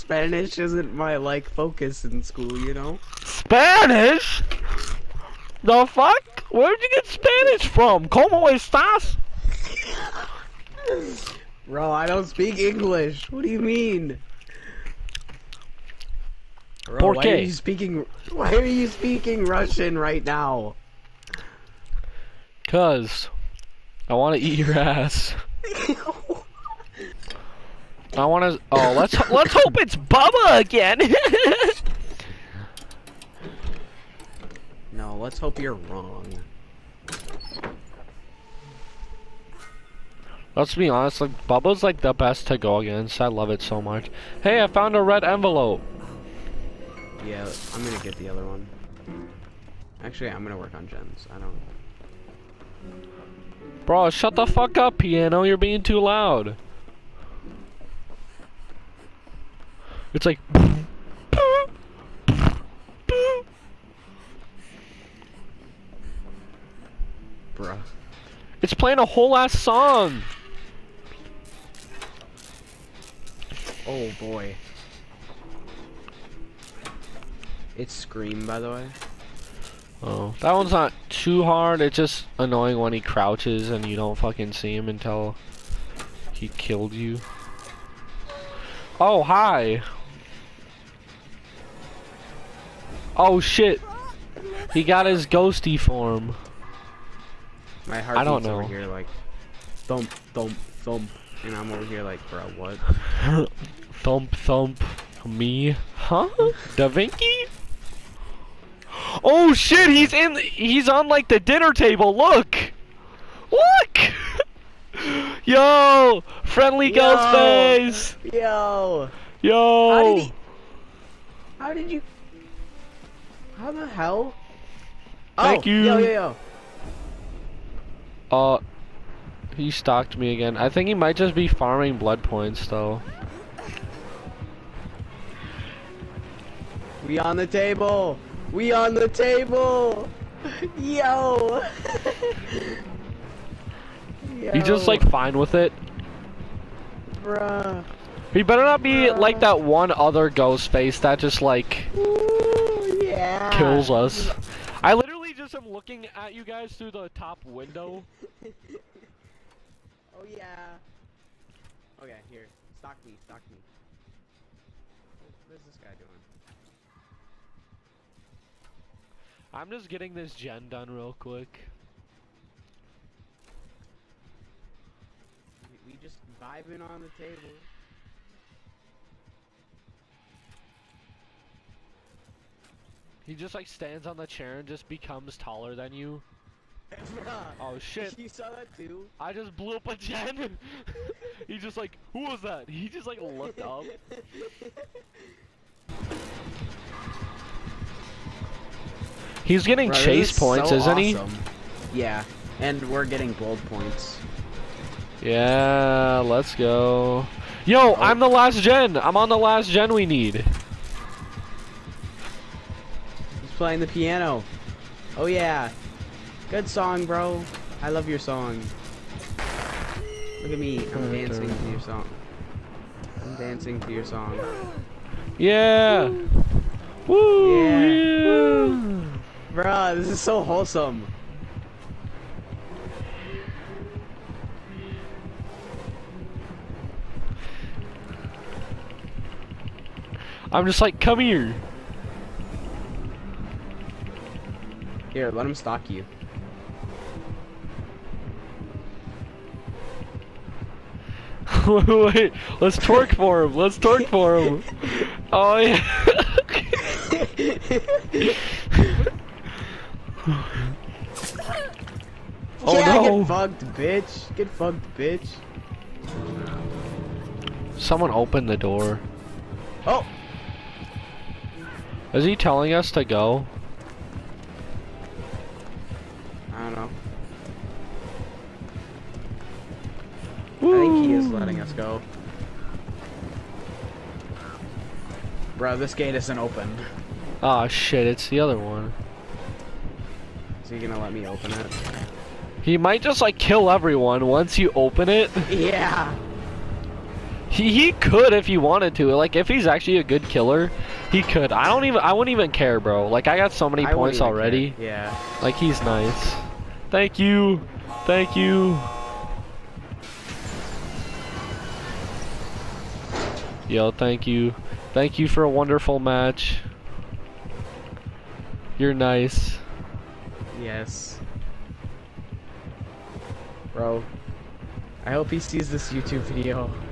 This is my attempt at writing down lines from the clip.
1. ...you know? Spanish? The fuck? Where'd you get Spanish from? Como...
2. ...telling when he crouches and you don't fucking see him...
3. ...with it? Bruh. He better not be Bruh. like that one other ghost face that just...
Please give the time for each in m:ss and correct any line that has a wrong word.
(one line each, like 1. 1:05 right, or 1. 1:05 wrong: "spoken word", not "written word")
1. 0:02 right
2. 1:22 wrong: "annoying", not "telling"
3. 2:25 right.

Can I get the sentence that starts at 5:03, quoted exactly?
Like I got so many I points already.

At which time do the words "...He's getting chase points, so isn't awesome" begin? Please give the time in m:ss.
3:19.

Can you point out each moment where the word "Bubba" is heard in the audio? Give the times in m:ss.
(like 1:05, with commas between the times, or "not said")
0:29, 0:41.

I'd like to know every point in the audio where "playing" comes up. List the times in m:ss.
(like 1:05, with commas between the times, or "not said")
1:08, 3:33.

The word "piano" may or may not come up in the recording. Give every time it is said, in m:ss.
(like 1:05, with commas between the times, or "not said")
0:54, 3:33.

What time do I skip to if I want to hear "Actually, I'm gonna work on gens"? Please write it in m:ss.
0:50.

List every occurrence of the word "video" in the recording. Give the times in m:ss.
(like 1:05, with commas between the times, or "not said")
5:26.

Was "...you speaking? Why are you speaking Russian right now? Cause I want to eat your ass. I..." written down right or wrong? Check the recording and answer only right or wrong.
right.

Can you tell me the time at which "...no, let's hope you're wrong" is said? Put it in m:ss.
0:34.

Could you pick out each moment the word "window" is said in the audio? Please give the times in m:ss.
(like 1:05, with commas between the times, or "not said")
2:37.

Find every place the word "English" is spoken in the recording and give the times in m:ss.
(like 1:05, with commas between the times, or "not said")
0:12.